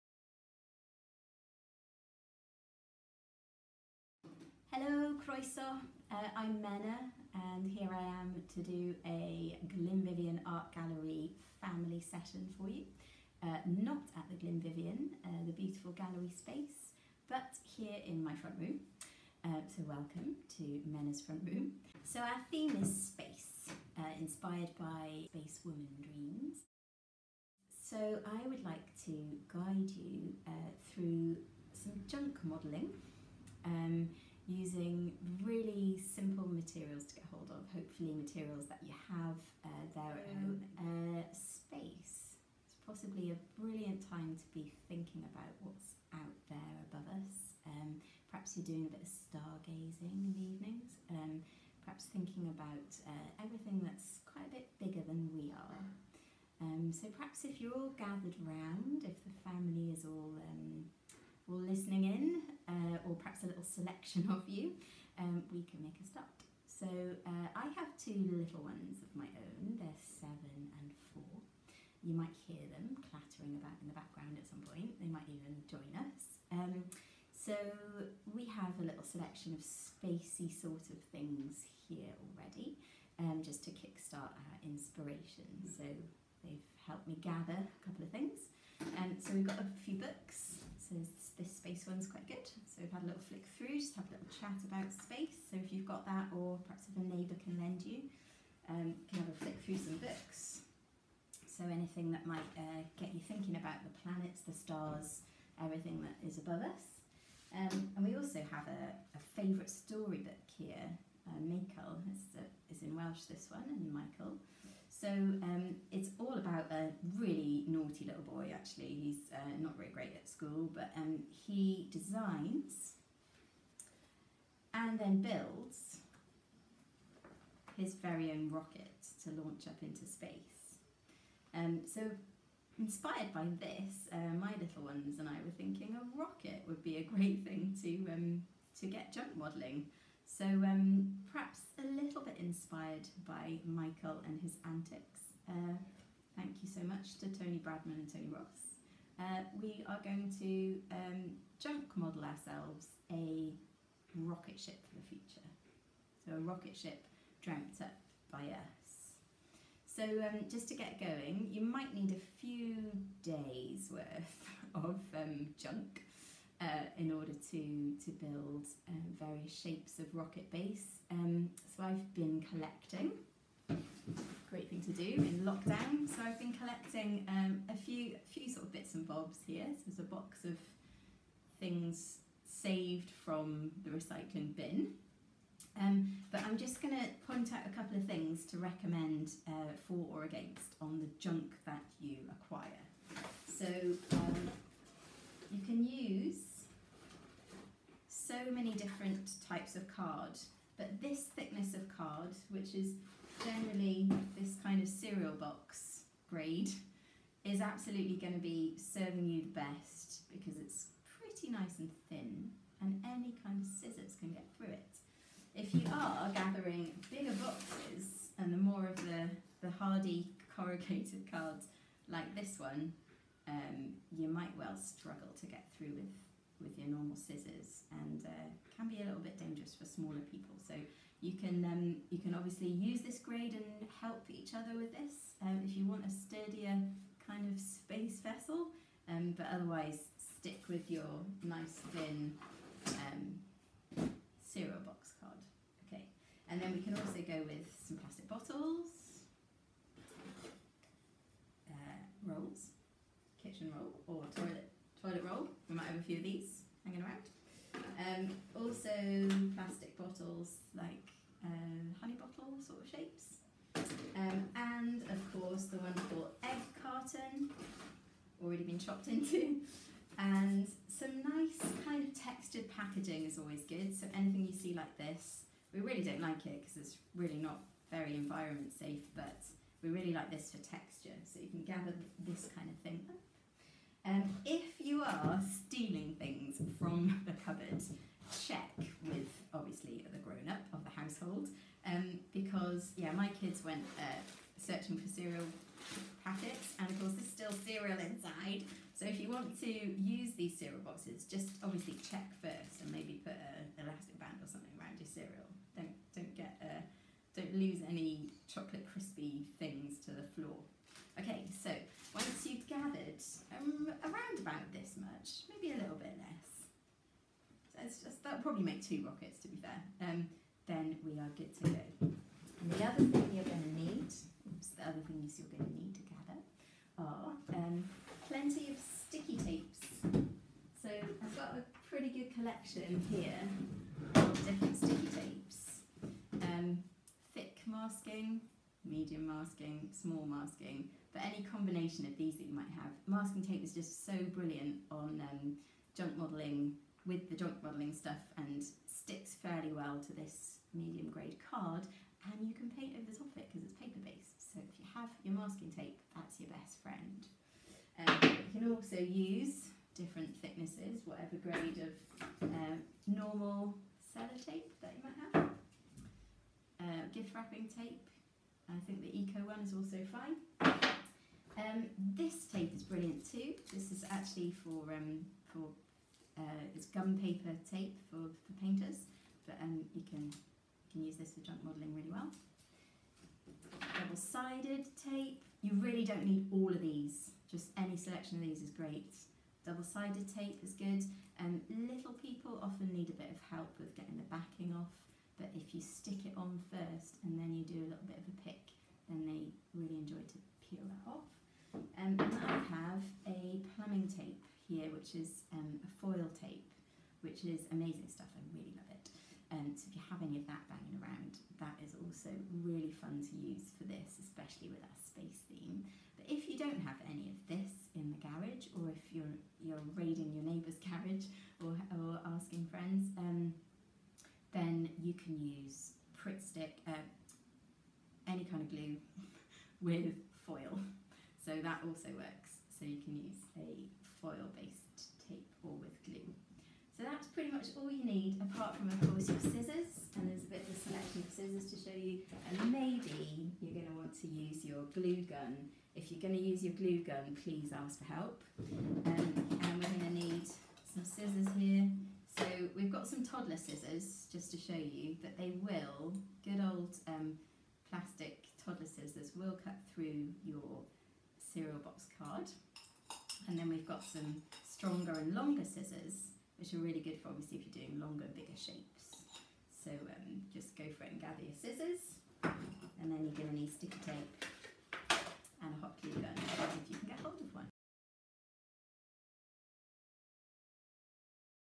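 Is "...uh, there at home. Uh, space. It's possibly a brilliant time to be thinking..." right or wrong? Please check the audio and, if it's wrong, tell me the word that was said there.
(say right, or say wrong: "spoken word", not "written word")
right.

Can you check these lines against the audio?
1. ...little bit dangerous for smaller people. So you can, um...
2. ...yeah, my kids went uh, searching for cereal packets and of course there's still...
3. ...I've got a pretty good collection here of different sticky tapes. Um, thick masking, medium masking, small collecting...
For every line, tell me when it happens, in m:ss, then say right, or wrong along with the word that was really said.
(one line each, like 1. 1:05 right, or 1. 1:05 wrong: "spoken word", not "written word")
1. 3:49 right
2. 4:52 right
3. 5:30 wrong: "masking", not "collecting".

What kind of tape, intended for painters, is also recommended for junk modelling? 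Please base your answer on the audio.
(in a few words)
Gum paper tape.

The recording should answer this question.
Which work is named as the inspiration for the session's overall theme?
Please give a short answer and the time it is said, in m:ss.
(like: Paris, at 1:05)
Space Woman Dreams, at 0:25.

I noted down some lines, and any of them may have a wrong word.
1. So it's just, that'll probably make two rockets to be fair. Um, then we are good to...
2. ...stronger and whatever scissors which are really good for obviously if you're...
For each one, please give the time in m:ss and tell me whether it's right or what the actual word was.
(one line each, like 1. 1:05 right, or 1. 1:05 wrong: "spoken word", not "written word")
1. 5:17 right
2. 7:44 wrong: "longer", not "whatever".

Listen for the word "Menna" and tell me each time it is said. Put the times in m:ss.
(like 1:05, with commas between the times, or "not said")
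0:06, 0:20.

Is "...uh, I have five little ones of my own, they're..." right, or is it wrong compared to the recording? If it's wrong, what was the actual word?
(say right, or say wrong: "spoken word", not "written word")
wrong: "two", not "five".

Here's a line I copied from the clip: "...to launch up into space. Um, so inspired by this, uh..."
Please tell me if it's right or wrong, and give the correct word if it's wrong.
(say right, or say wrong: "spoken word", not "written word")
right.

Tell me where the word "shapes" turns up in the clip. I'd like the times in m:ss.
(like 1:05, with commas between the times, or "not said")
2:49, 4:22, 7:48.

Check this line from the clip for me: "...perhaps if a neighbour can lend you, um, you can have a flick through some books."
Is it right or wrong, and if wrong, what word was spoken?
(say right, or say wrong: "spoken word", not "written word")
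right.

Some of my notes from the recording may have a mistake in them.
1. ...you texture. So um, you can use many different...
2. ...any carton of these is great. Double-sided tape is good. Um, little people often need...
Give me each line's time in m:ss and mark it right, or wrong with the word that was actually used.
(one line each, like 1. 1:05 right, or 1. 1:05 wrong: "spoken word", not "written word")
1. 3:11 wrong: "acquire", not "texture"
2. 6:27 wrong: "selection", not "carton".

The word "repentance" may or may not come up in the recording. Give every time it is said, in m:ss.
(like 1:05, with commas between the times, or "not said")
not said.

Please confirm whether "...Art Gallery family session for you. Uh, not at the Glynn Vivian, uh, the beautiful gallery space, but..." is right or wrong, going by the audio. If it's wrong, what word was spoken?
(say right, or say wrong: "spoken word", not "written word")
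right.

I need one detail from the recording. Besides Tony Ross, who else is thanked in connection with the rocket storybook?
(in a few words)
Tony Bradman.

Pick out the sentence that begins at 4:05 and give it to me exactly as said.
Okay, and then we can also go with some plastic bottles, uh, rolls, kitchen roll or toilet toilet roll.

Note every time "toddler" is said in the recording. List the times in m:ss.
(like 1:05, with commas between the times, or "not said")
7:33, 7:38.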